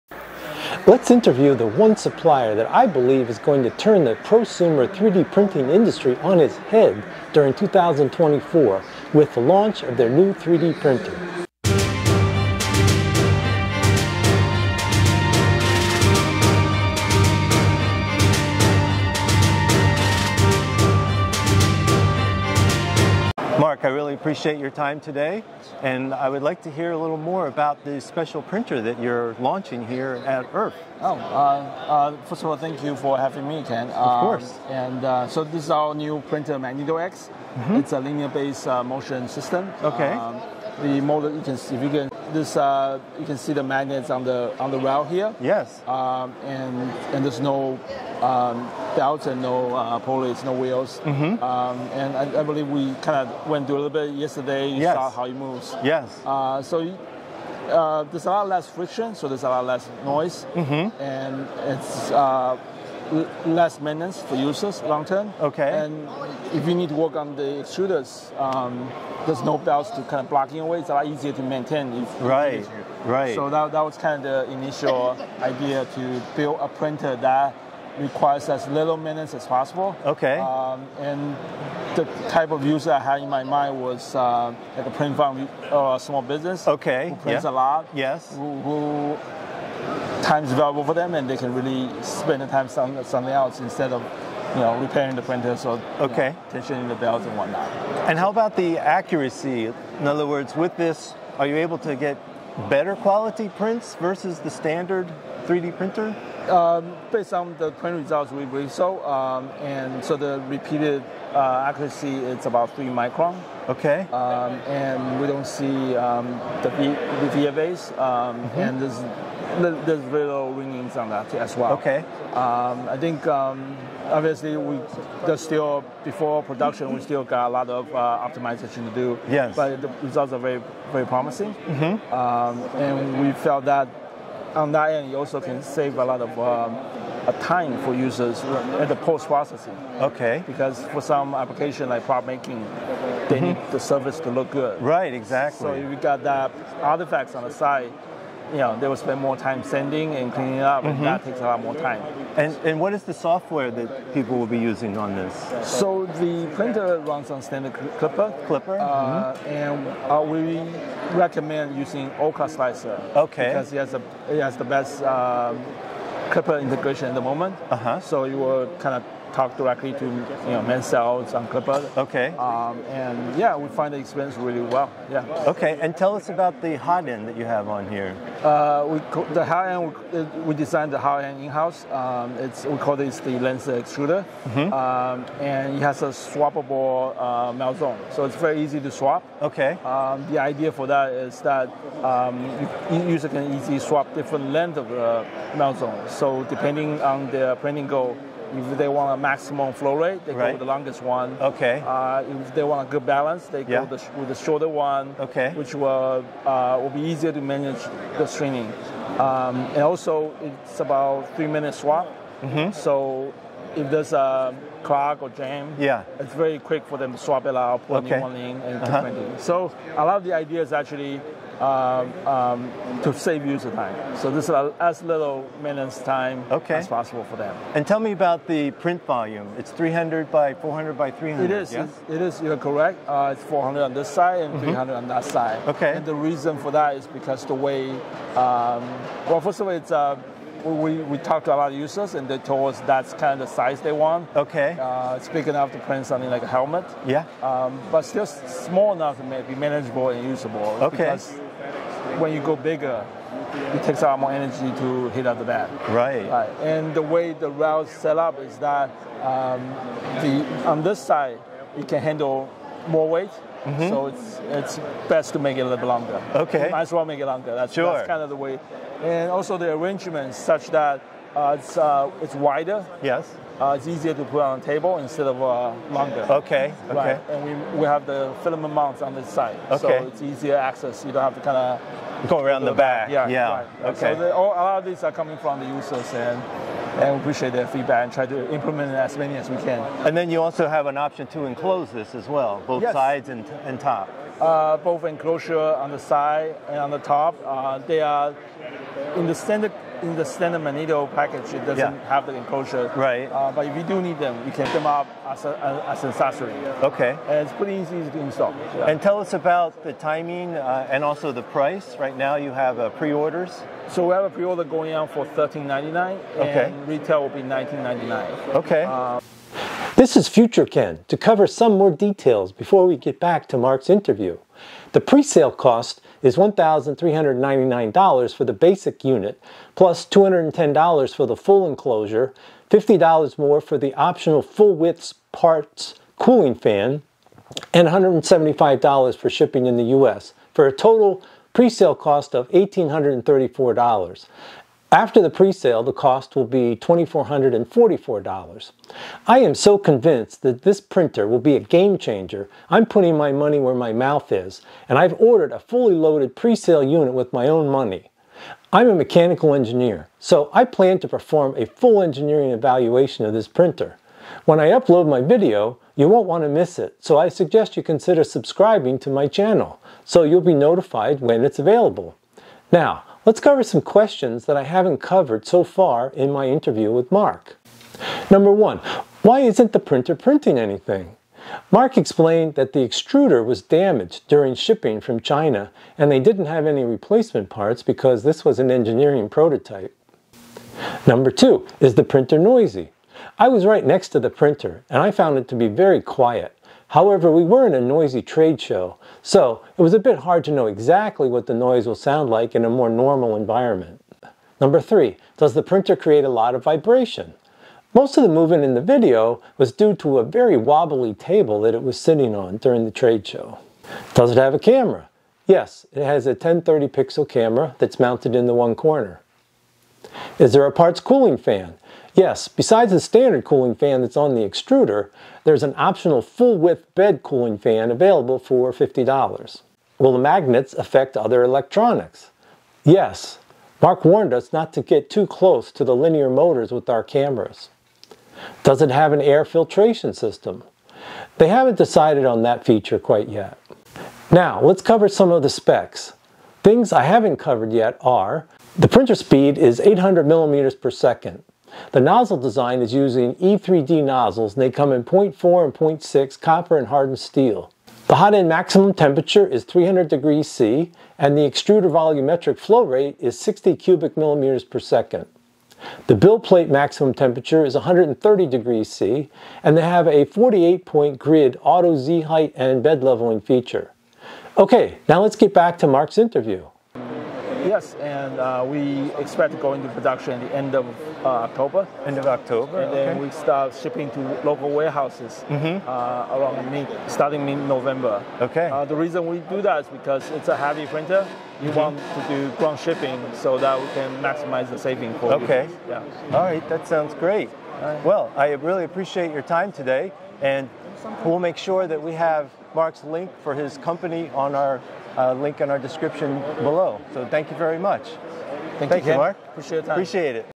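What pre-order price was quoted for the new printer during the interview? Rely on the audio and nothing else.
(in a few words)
$1,399.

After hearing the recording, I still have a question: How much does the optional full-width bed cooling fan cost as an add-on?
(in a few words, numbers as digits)
$50.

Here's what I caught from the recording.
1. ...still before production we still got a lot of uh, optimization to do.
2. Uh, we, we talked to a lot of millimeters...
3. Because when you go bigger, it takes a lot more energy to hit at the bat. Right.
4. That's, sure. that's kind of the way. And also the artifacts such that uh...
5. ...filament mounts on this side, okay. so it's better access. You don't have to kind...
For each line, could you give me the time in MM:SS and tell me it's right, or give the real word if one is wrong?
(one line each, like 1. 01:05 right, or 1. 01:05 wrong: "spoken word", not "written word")
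1. 02:05 right
2. 03:59 wrong: "users", not "millimeters"
3. 04:10 right
4. 04:27 wrong: "arrangements", not "artifacts"
5. 04:38 wrong: "easier", not "better".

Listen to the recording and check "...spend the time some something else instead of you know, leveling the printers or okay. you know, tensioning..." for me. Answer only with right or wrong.
wrong.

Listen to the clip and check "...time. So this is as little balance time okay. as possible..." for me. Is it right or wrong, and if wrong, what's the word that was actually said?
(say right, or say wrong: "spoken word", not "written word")
wrong: "maintenance", not "balance".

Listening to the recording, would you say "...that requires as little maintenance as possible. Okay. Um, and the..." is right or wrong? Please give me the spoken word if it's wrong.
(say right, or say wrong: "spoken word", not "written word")
right.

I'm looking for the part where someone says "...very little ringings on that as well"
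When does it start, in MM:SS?
01:59.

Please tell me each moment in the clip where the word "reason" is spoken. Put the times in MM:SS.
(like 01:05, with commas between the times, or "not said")
03:56, 08:08.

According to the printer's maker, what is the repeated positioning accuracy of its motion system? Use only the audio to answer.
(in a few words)
3 microns.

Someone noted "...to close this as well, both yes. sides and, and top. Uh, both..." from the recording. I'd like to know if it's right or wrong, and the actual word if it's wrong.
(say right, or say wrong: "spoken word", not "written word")
wrong: "enclose", not "close".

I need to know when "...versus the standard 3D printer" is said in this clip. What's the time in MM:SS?
01:43.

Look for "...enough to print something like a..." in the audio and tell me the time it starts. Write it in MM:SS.
04:05.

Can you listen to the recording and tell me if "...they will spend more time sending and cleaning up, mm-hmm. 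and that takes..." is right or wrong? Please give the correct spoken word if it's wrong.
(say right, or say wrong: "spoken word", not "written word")
right.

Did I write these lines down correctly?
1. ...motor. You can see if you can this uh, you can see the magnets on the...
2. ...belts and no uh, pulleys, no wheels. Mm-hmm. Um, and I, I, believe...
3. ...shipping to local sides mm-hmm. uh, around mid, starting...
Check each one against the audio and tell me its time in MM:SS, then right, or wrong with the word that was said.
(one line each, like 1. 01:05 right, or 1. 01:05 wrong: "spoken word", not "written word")
1. 00:41 right
2. 00:48 right
3. 08:03 wrong: "warehouses", not "sides".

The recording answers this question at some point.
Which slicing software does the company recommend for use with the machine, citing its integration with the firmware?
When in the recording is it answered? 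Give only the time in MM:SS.
02:42.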